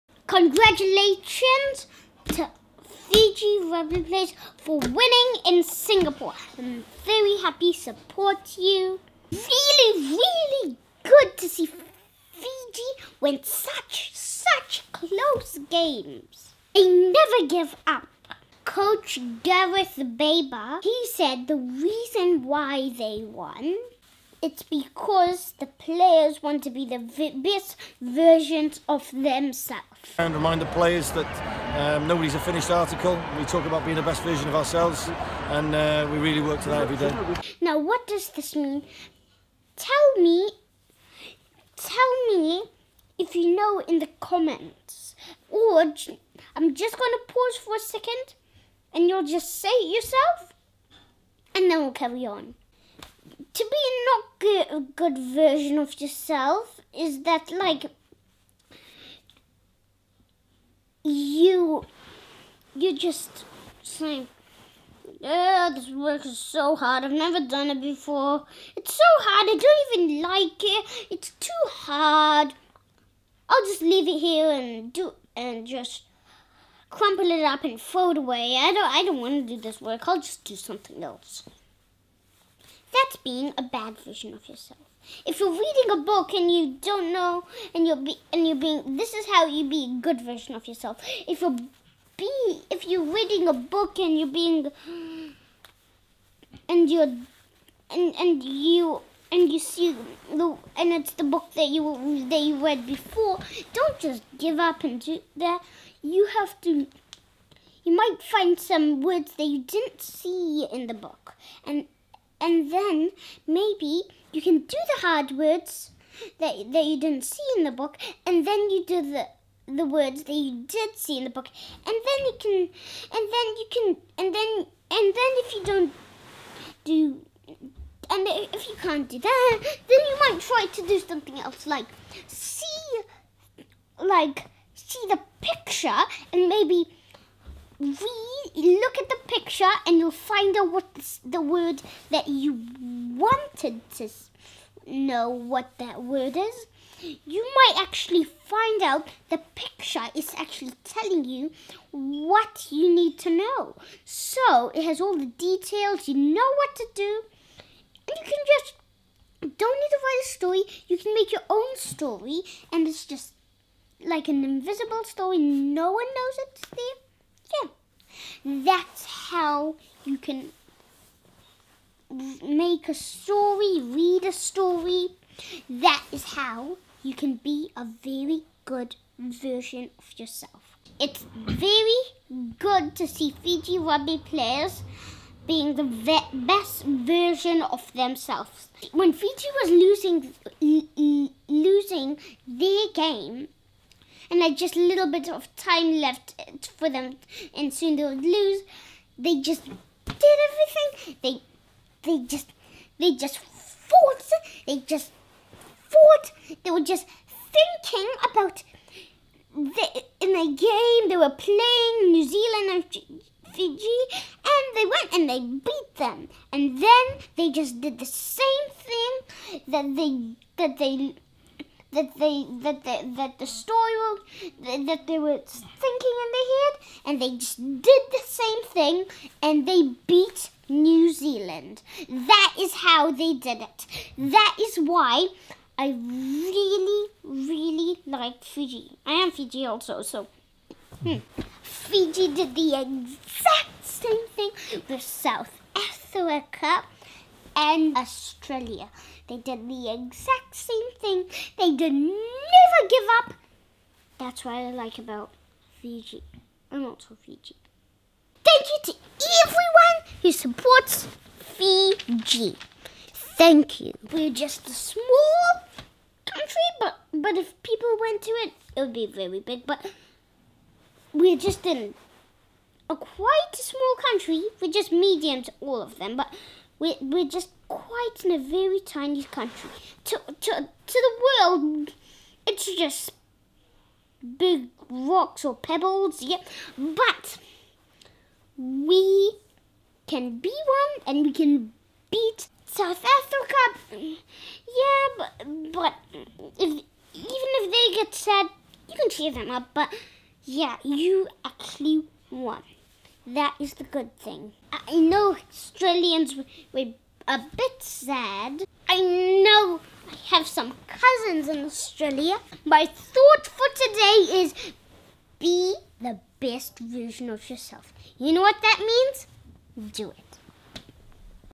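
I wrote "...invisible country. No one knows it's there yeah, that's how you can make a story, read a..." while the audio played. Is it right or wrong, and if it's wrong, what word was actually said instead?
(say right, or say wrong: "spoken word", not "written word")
wrong: "story", not "country".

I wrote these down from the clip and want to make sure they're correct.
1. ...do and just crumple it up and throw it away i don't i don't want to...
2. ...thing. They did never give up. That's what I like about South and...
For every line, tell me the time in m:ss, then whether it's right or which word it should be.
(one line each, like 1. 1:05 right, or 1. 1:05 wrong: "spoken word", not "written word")
1. 1:14 right
2. 4:10 wrong: "Fiji", not "South".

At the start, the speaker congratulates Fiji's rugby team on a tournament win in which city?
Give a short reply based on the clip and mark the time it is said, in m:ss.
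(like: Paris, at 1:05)
Singapore, at 0:05.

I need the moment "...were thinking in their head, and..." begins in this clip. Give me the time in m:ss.
3:45.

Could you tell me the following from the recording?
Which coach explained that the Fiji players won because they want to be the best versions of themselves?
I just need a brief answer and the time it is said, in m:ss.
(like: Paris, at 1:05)
Gareth Baber, at 0:19.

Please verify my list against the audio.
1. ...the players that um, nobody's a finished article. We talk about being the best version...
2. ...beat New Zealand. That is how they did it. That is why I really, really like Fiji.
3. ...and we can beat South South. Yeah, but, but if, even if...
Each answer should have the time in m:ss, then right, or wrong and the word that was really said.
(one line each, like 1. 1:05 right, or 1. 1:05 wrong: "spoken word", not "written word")
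1. 0:30 right
2. 3:50 right
3. 4:51 wrong: "Africa", not "South".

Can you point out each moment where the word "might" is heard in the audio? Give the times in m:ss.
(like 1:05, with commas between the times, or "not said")
1:47, 2:10, 2:27.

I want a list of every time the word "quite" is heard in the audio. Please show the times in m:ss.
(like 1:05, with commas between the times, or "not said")
4:32, 4:37.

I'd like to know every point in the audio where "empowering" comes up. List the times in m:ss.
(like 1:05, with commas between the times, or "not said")
not said.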